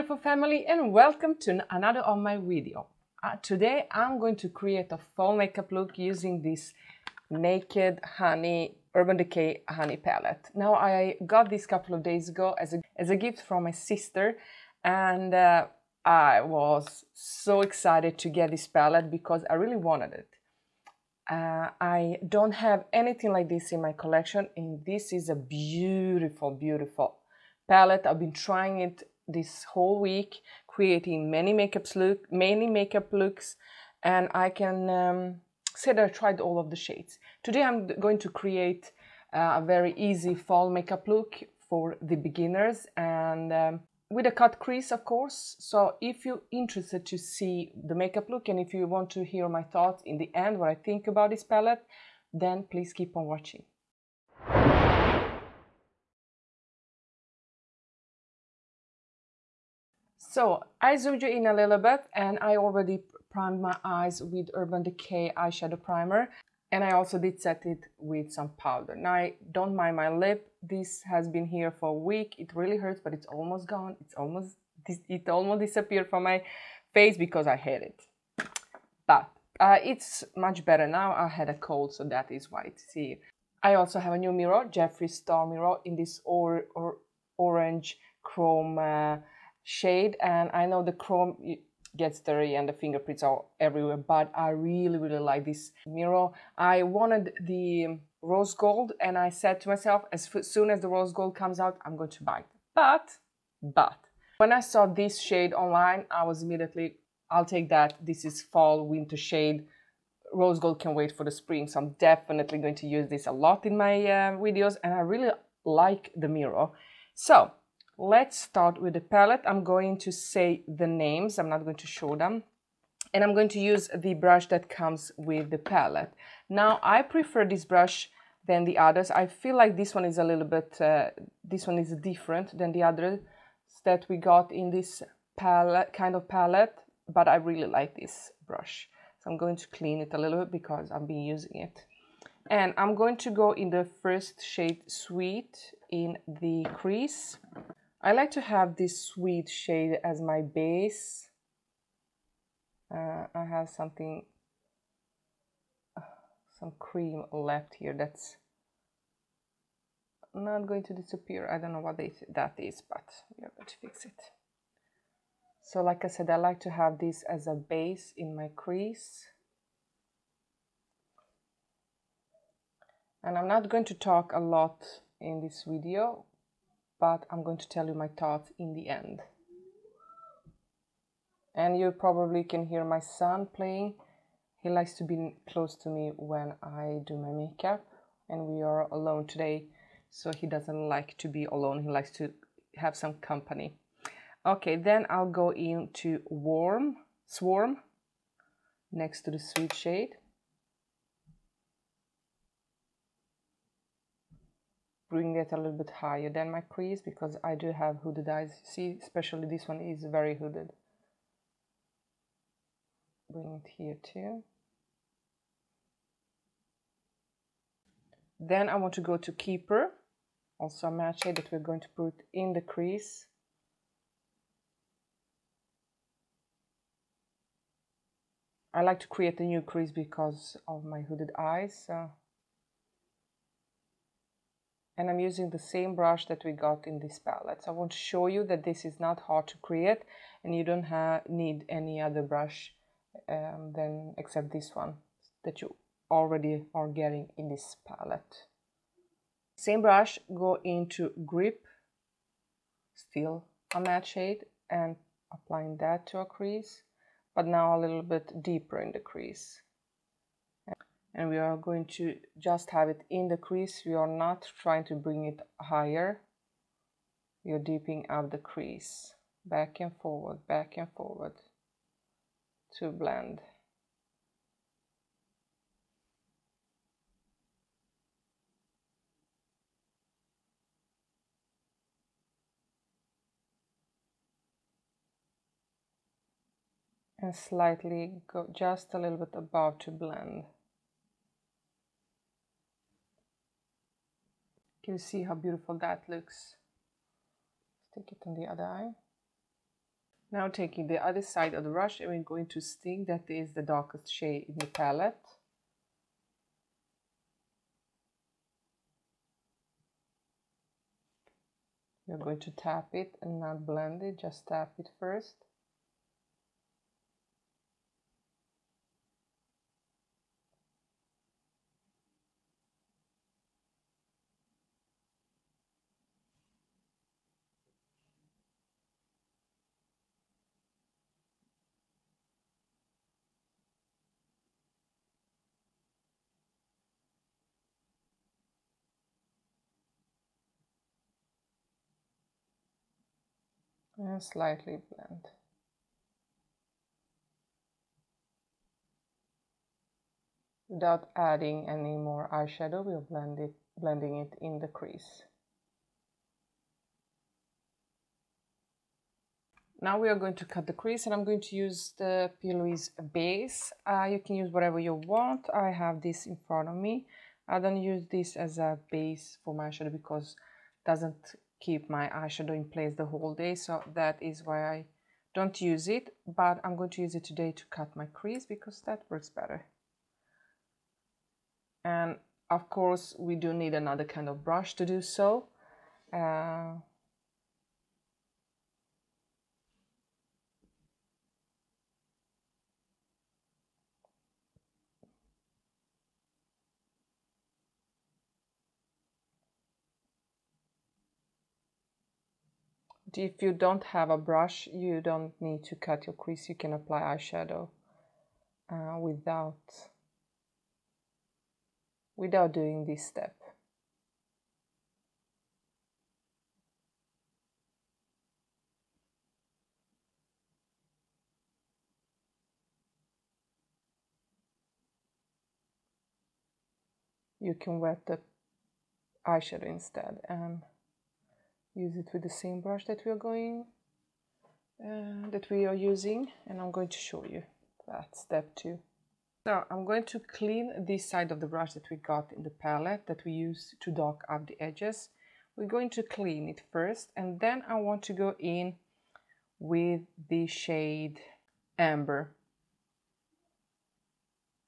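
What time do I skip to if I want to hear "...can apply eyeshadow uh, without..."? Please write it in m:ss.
6:46.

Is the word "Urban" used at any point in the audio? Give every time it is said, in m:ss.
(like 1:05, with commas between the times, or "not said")
0:08, 1:04.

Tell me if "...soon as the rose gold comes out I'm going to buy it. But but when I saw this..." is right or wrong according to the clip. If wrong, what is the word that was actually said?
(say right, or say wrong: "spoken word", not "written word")
right.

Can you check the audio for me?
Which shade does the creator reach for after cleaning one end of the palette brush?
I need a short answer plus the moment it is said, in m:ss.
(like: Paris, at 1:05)
Amber, at 7:31.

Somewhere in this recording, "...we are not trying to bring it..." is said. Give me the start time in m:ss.
4:23.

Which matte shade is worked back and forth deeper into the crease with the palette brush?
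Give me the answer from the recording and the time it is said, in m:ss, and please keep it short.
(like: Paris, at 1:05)
Grip, at 4:11.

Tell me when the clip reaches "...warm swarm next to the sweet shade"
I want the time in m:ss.
3:16.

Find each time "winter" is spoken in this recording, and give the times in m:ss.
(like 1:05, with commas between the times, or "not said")
1:48.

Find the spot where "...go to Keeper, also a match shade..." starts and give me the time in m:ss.
3:39.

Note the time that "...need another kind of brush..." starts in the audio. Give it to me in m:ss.
6:23.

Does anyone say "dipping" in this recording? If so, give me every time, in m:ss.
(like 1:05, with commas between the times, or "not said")
4:27.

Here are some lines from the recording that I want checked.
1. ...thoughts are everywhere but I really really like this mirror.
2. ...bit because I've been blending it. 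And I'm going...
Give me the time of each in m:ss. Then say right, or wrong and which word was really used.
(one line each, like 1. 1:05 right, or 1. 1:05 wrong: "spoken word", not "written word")
1. 1:32 wrong: "fingerprints", not "thoughts"
2. 2:20 wrong: "using", not "blending".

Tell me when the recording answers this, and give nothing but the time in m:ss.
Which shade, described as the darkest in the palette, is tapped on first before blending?
5:02.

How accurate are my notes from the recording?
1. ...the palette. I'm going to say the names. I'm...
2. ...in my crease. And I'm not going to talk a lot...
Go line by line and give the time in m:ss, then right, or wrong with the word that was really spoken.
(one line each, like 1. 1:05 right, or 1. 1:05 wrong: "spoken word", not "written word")
1. 1:58 right
2. 2:48 right.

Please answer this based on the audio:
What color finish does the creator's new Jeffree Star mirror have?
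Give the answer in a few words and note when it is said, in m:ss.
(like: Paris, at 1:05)
orange chrome, at 1:27.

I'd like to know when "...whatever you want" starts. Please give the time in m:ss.
6:04.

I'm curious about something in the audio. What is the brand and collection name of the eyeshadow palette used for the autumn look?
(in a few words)
Naked Honey.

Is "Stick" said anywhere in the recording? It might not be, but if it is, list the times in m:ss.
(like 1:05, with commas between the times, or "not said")
4:57.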